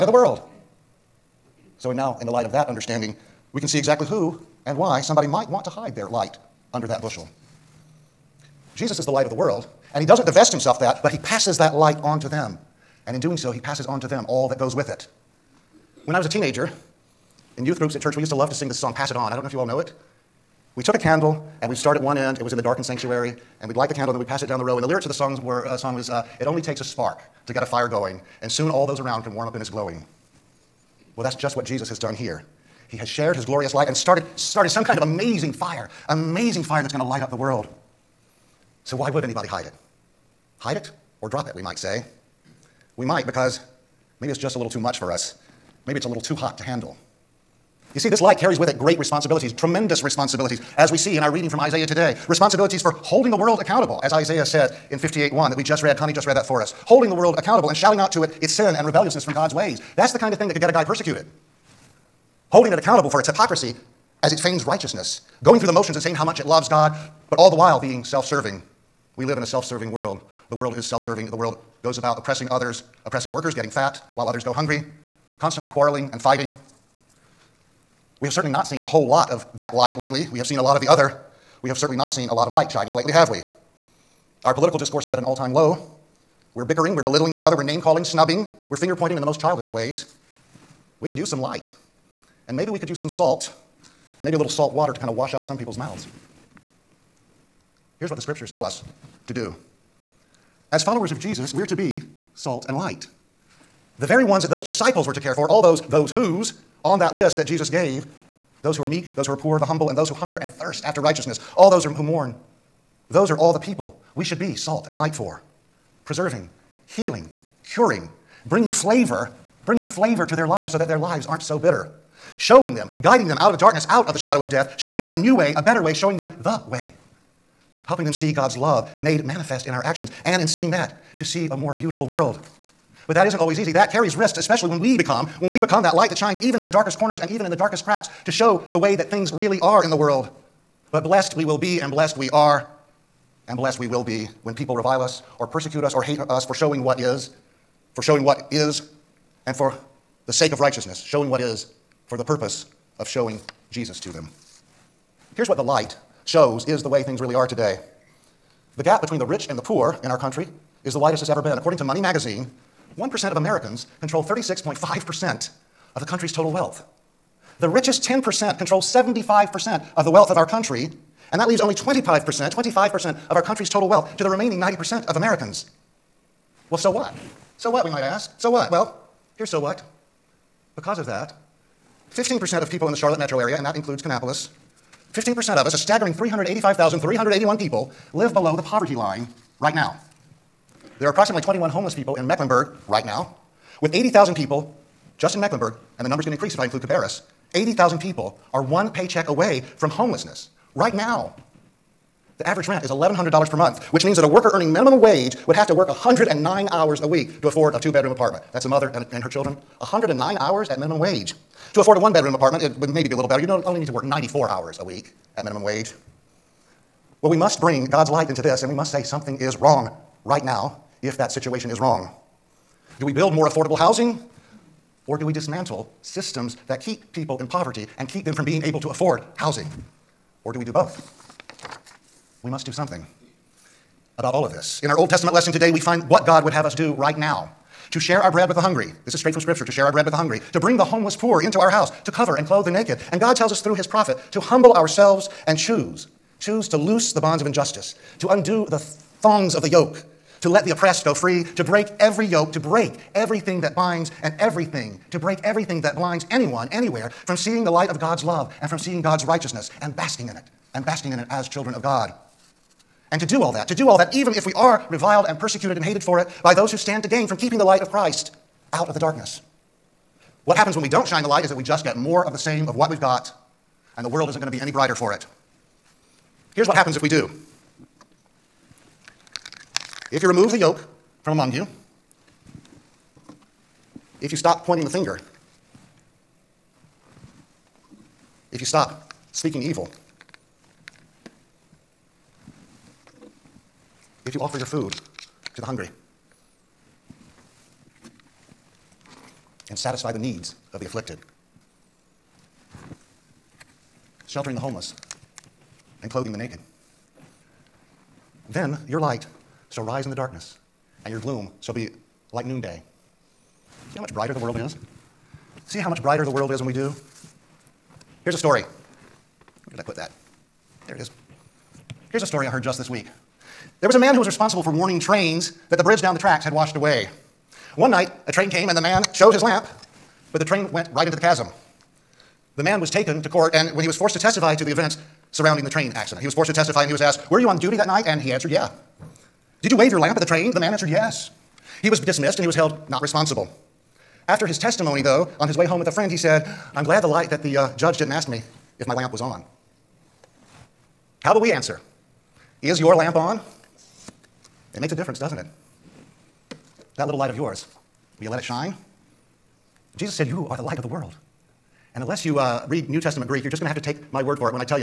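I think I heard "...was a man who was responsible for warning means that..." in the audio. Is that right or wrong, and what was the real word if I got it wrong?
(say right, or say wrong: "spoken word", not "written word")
wrong: "trains", not "means".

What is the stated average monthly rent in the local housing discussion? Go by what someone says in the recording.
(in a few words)
$1,100.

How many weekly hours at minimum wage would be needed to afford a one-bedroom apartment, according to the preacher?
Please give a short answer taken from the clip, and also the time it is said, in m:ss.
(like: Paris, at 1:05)
94, at 3:34.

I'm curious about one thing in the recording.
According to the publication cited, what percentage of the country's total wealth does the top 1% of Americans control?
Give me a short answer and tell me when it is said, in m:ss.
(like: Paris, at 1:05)
36.5%, at 2:44.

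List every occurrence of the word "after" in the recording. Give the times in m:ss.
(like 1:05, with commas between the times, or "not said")
1:50, 5:44.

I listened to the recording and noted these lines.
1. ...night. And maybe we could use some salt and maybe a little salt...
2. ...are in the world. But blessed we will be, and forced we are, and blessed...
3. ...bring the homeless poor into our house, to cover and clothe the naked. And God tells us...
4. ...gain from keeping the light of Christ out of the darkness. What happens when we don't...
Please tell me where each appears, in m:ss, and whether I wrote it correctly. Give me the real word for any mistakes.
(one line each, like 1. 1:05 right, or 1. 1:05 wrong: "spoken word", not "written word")
1. 1:31 wrong: "light", not "night"
2. 2:19 wrong: "blessed", not "forced"
3. 4:00 right
4. 4:27 right.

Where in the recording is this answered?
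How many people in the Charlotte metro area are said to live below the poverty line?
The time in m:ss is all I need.
3:06.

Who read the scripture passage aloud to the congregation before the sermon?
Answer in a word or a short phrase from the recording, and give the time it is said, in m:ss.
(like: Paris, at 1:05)
Connie, at 0:55.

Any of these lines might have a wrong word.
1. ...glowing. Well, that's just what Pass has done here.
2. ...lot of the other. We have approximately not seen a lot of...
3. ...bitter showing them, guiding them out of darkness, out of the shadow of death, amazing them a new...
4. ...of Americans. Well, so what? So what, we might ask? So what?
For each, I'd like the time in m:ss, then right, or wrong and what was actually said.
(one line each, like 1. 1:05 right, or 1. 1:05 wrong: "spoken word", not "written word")
1. 0:29 wrong: "Jesus", not "Pass"
2. 1:20 wrong: "certainly", not "approximately"
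3. 2:01 wrong: "showing", not "amazing"
4. 2:55 right.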